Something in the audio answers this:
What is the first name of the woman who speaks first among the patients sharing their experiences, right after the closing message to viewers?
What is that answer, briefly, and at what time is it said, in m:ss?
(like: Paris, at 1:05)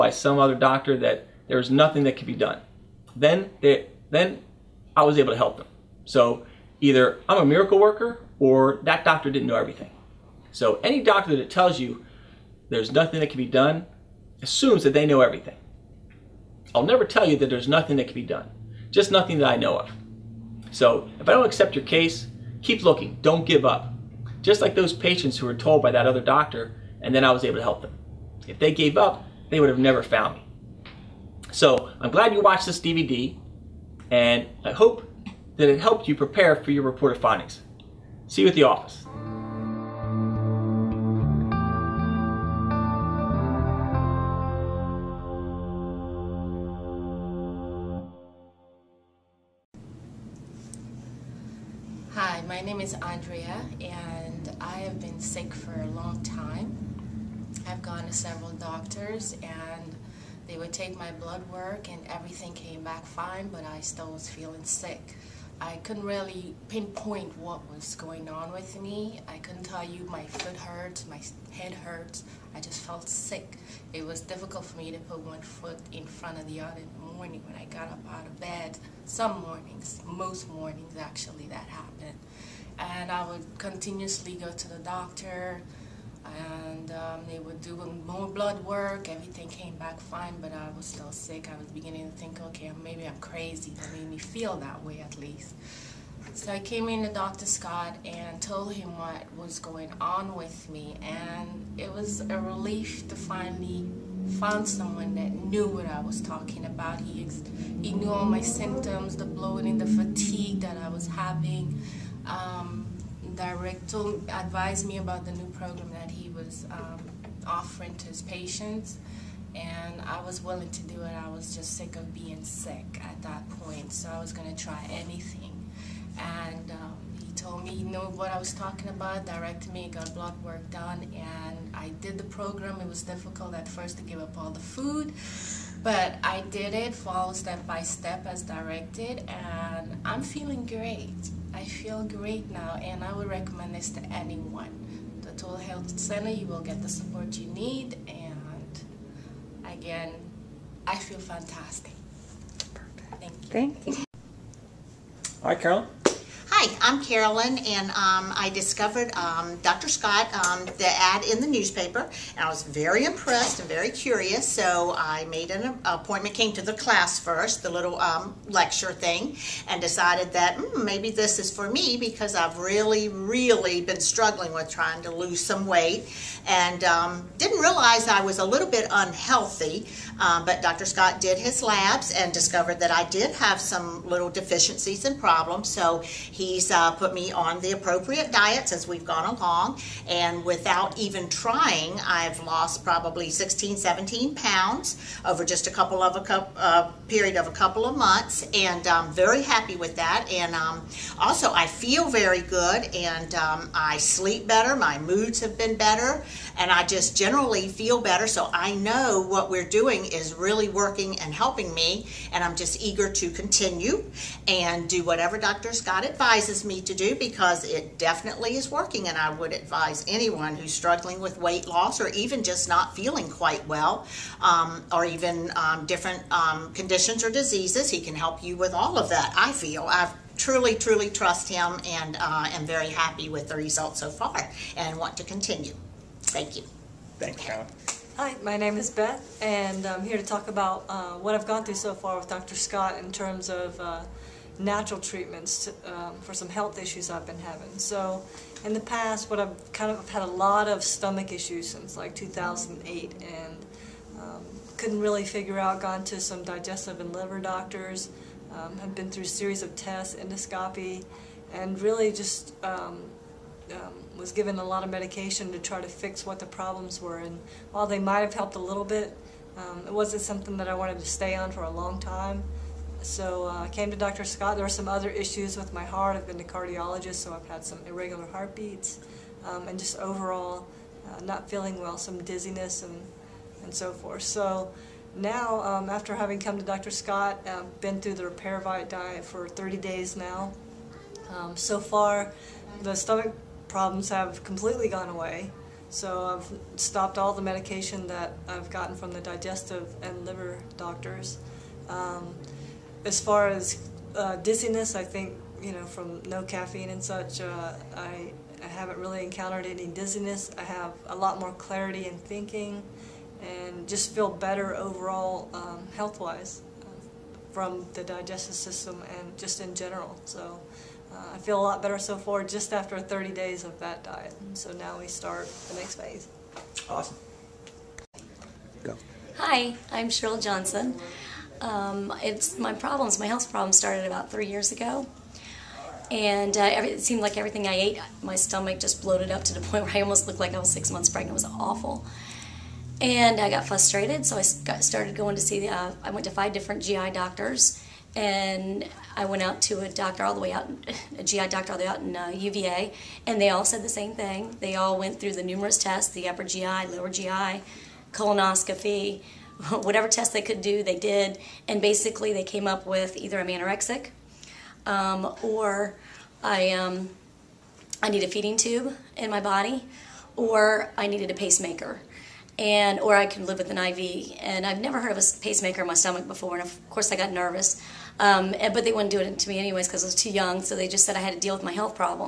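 Andrea, at 0:53.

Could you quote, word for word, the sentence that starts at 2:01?
I was just sick of being sick at that point, so I was going to try anything.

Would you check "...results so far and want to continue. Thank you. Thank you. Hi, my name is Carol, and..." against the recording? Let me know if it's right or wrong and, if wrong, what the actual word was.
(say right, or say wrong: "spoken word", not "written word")
wrong: "Beth", not "Carol".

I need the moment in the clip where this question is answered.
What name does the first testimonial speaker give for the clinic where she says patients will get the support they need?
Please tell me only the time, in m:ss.
2:25.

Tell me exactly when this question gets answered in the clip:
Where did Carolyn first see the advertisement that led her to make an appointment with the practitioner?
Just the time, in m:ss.
2:41.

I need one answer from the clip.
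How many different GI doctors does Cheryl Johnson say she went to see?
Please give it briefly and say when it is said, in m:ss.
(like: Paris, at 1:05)
5, at 5:46.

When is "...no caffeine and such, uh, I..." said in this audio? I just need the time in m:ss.
5:06.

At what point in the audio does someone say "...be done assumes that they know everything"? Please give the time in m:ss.
0:13.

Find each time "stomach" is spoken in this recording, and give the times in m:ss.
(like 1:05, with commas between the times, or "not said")
4:10, 4:52, 5:38, 6:15.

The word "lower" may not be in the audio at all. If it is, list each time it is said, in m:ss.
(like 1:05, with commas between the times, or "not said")
5:56.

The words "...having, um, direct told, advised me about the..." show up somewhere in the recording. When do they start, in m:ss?
1:51.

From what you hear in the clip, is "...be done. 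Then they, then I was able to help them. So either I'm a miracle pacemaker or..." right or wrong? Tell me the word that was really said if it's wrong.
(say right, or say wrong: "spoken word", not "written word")
wrong: "worker", not "pacemaker".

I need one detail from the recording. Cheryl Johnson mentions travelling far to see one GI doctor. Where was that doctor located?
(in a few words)
UVA.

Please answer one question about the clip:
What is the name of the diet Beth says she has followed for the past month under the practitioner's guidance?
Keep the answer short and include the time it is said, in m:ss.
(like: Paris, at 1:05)
Repairvite, at 4:48.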